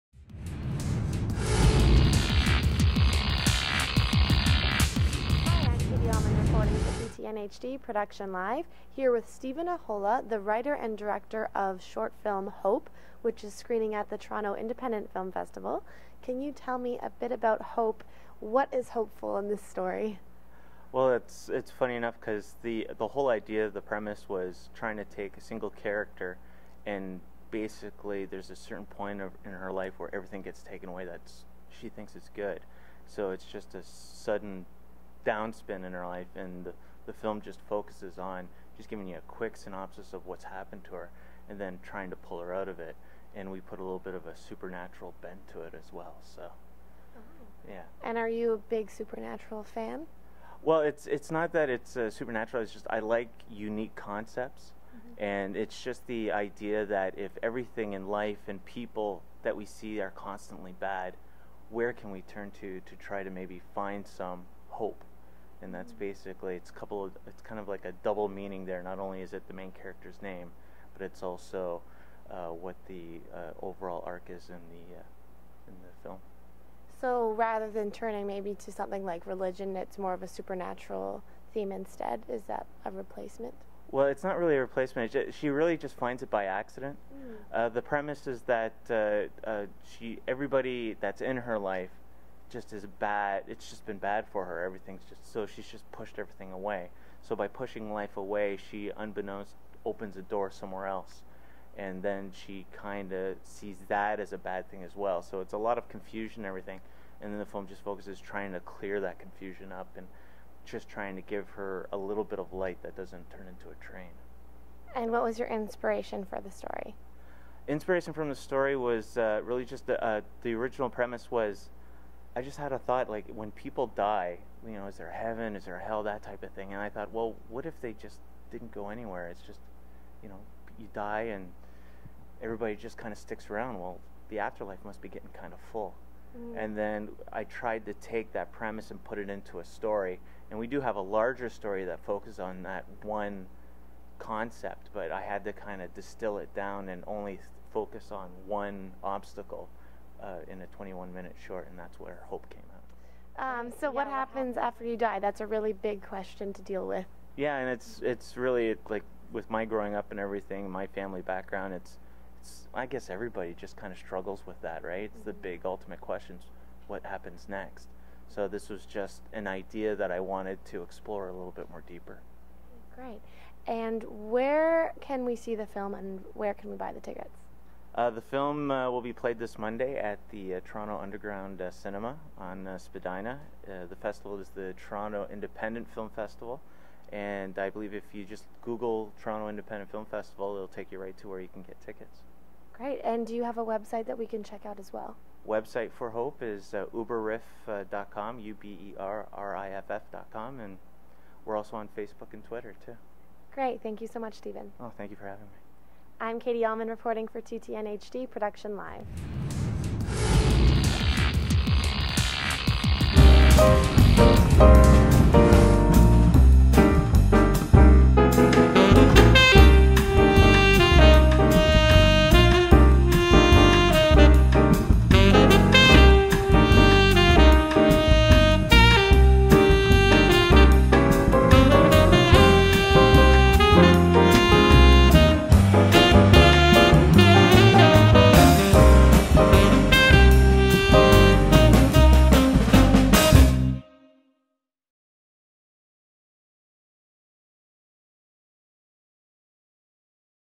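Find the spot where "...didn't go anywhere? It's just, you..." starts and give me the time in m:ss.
2:08.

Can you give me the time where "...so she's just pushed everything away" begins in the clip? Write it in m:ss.
1:35.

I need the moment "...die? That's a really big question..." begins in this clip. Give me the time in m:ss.
2:34.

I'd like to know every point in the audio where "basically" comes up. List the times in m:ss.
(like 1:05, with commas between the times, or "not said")
0:27, 1:05.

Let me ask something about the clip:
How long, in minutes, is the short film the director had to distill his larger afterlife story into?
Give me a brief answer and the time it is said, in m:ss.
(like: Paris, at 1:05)
21, at 2:30.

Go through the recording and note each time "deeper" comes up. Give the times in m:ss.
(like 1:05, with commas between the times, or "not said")
2:51.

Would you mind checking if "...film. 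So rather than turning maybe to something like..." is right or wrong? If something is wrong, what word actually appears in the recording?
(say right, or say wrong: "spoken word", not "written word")
right.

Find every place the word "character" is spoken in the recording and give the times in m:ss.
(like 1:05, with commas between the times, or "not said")
0:25, 1:09.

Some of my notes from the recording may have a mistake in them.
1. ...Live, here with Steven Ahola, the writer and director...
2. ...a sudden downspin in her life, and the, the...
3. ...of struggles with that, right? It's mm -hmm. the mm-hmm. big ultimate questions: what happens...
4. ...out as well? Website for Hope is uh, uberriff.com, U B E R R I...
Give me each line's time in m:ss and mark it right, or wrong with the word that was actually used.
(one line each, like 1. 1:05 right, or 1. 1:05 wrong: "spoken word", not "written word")
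1. 0:08 right
2. 0:33 right
3. 2:43 right
4. 3:14 right.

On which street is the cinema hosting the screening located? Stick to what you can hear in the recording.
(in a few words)
Spadina.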